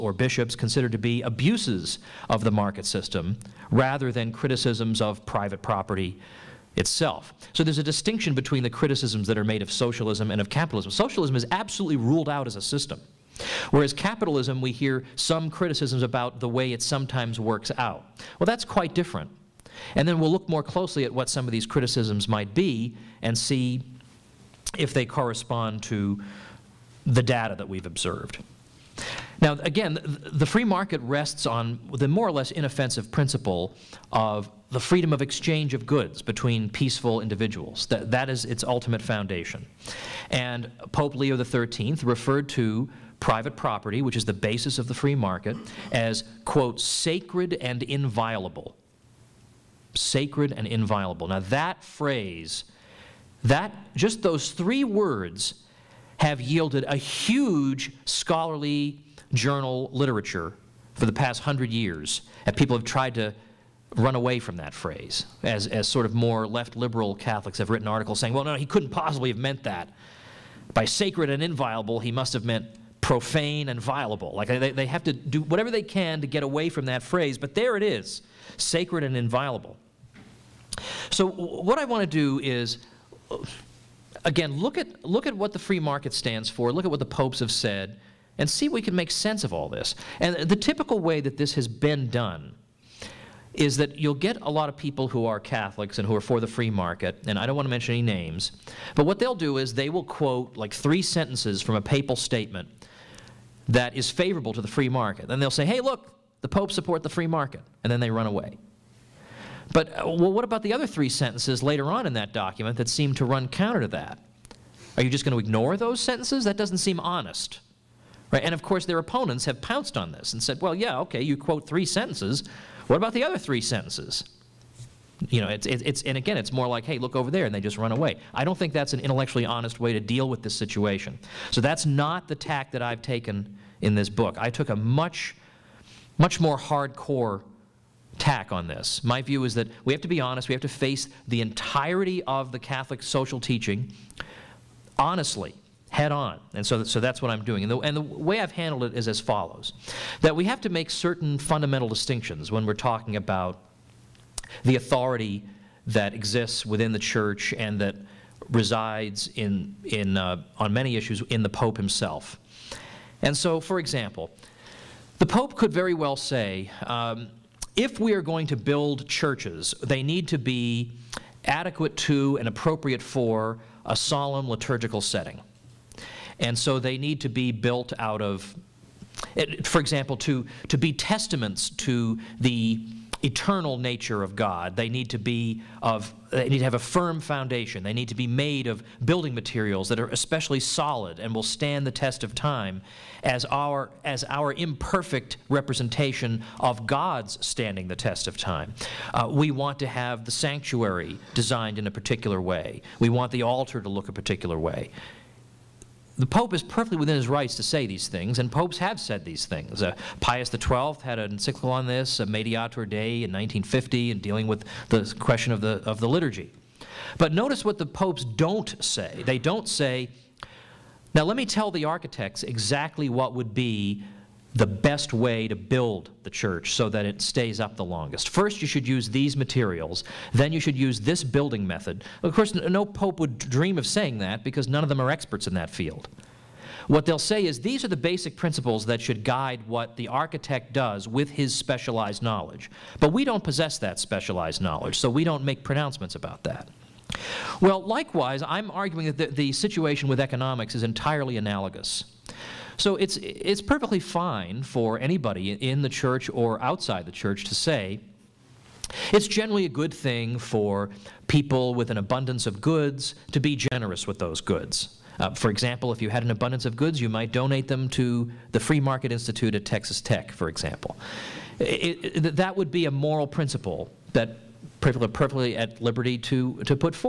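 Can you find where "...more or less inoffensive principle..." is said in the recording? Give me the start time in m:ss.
0:32.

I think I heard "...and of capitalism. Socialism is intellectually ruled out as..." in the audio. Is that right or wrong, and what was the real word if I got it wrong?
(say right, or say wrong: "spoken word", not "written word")
wrong: "absolutely", not "intellectually".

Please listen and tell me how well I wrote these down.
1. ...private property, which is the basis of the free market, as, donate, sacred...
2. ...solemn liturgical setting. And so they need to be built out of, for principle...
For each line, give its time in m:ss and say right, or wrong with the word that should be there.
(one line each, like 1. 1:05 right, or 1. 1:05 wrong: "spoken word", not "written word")
1. 0:43 wrong: "quote", not "donate"
2. 2:53 wrong: "example", not "principle".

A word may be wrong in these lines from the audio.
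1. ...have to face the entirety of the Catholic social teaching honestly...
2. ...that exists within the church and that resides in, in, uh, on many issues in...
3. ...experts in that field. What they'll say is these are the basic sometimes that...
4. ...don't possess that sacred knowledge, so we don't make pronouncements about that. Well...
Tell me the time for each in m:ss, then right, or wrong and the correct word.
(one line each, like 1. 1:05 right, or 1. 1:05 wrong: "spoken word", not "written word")
1. 2:20 right
2. 2:35 right
3. 3:55 wrong: "principles", not "sometimes"
4. 4:03 wrong: "specialized", not "sacred".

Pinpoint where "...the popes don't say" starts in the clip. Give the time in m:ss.
3:37.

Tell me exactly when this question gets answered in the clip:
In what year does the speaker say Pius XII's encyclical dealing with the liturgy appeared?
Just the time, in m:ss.
3:33.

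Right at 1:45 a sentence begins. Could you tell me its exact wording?
Then they'll say, hey, look, the Pope support the free market, and then they run away.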